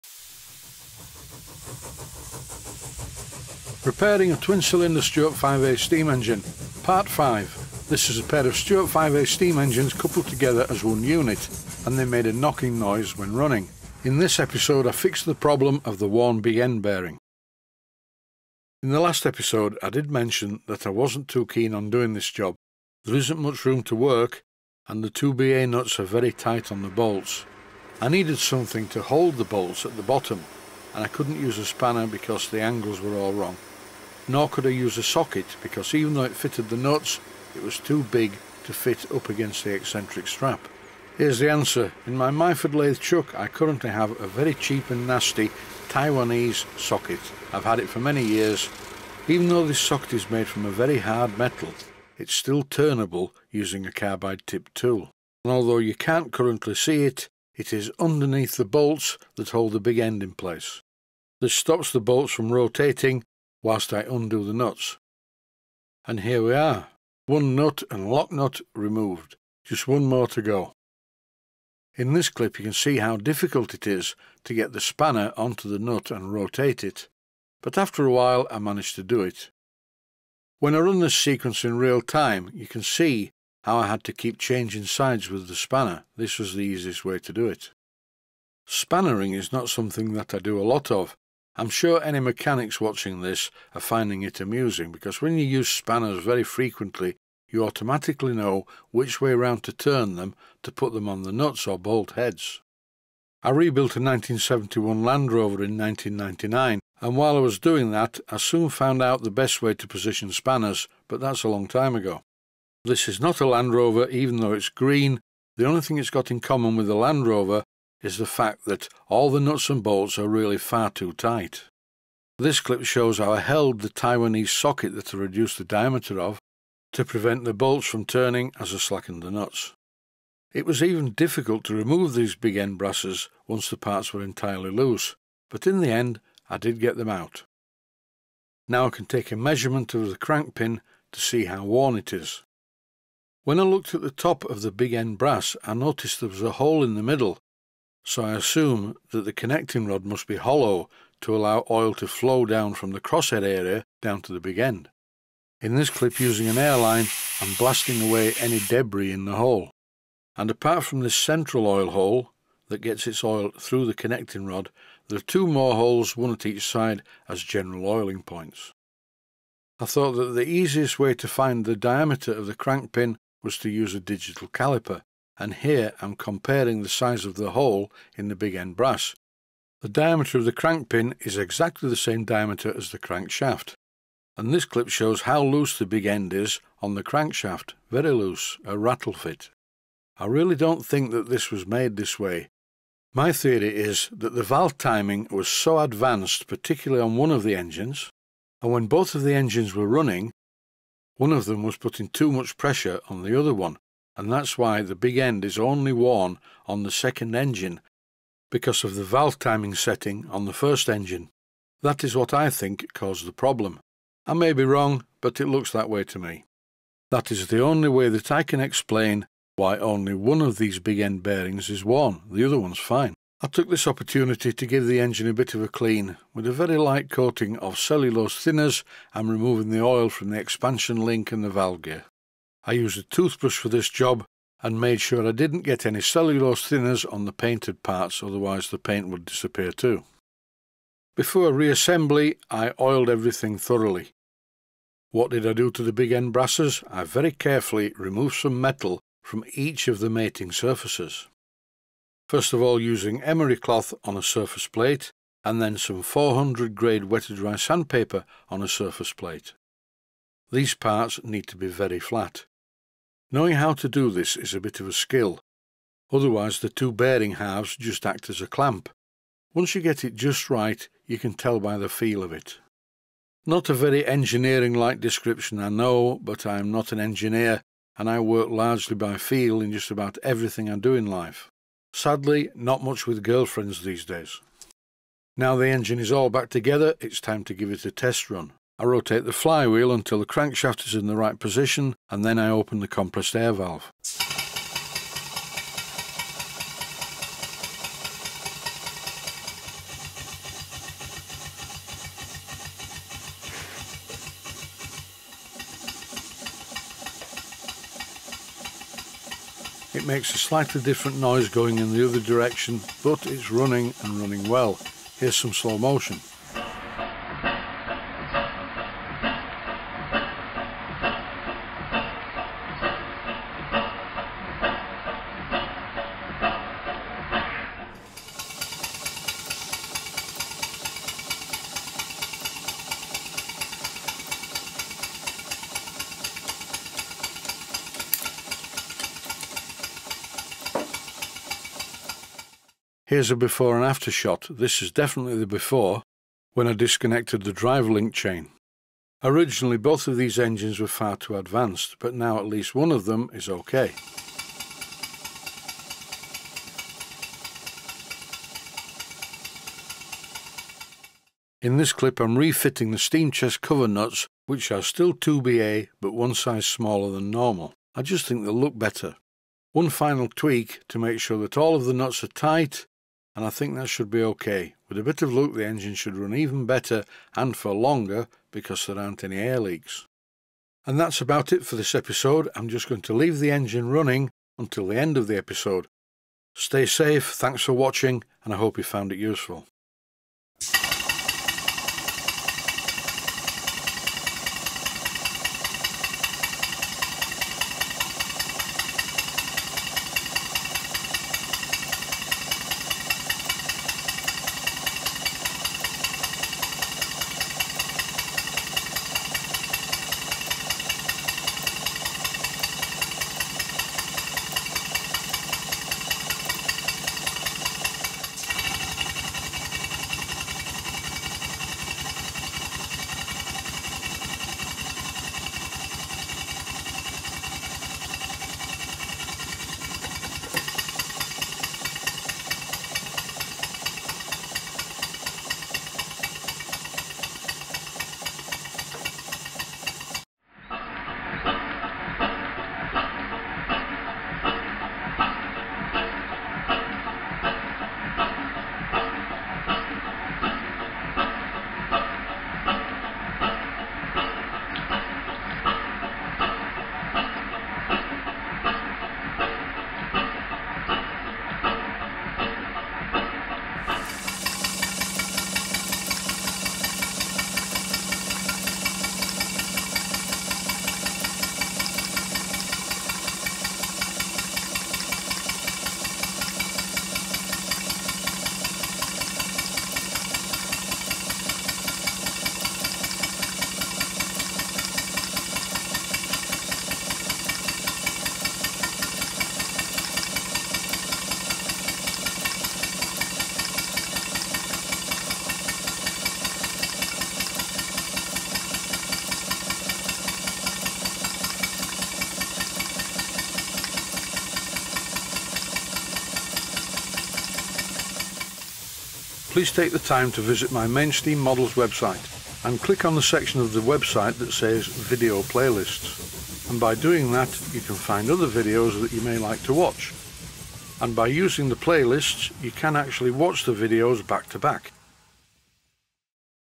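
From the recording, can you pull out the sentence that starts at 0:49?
Even though this socket is made from a very hard metal, it's still turnable using a carbide tip tool.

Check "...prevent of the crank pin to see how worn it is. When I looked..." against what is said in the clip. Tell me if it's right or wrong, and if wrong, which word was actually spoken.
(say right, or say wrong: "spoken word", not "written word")
wrong: "measurement", not "prevent".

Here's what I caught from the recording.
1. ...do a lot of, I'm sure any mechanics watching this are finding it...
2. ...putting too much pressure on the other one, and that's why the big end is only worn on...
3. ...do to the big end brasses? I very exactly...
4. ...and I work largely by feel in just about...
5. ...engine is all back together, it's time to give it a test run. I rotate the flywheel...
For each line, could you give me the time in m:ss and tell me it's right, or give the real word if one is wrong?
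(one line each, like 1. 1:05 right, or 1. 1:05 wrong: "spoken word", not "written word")
1. 1:30 right
2. 3:21 right
3. 4:05 wrong: "carefully", not "exactly"
4. 4:37 right
5. 4:45 right.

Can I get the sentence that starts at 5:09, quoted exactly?
It makes a slightly different noise going in the other direction, but it's running and running well.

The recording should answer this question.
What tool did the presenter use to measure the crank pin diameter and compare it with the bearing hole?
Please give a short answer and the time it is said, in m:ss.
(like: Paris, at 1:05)
digital caliper, at 2:53.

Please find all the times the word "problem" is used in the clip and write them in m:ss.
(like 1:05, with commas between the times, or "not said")
0:15, 3:33.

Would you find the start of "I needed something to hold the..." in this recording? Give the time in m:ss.
0:27.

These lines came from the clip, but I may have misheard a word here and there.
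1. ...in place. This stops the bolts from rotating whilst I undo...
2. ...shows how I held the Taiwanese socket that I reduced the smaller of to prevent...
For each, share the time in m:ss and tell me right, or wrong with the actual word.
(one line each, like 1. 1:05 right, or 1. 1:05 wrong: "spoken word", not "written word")
1. 1:00 right
2. 2:02 wrong: "diameter", not "smaller".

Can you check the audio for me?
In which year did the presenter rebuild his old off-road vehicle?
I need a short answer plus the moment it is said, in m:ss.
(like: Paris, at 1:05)
1999, at 1:45.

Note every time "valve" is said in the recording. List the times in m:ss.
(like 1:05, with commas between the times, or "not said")
3:14, 3:29, 3:51, 4:53.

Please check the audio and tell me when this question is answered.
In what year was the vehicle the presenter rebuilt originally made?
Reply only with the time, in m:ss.
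1:43.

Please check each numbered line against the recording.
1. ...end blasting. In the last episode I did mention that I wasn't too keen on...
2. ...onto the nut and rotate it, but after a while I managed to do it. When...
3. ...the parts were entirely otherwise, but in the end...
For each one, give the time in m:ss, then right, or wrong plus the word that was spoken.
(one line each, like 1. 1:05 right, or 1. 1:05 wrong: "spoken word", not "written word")
1. 0:16 wrong: "bearing", not "blasting"
2. 1:15 right
3. 2:13 wrong: "loose", not "otherwise".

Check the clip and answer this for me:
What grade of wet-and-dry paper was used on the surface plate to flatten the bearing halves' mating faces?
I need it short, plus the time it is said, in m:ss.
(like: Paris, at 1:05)
400, at 4:16.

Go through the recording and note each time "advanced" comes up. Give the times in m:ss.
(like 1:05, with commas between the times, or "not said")
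3:15, 5:51.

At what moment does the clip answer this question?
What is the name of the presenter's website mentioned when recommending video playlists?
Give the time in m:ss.
8:30.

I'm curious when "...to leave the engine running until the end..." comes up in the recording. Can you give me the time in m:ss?
6:23.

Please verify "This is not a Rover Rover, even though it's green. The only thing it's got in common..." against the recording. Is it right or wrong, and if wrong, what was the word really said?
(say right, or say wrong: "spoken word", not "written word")
wrong: "Land", not "Rover".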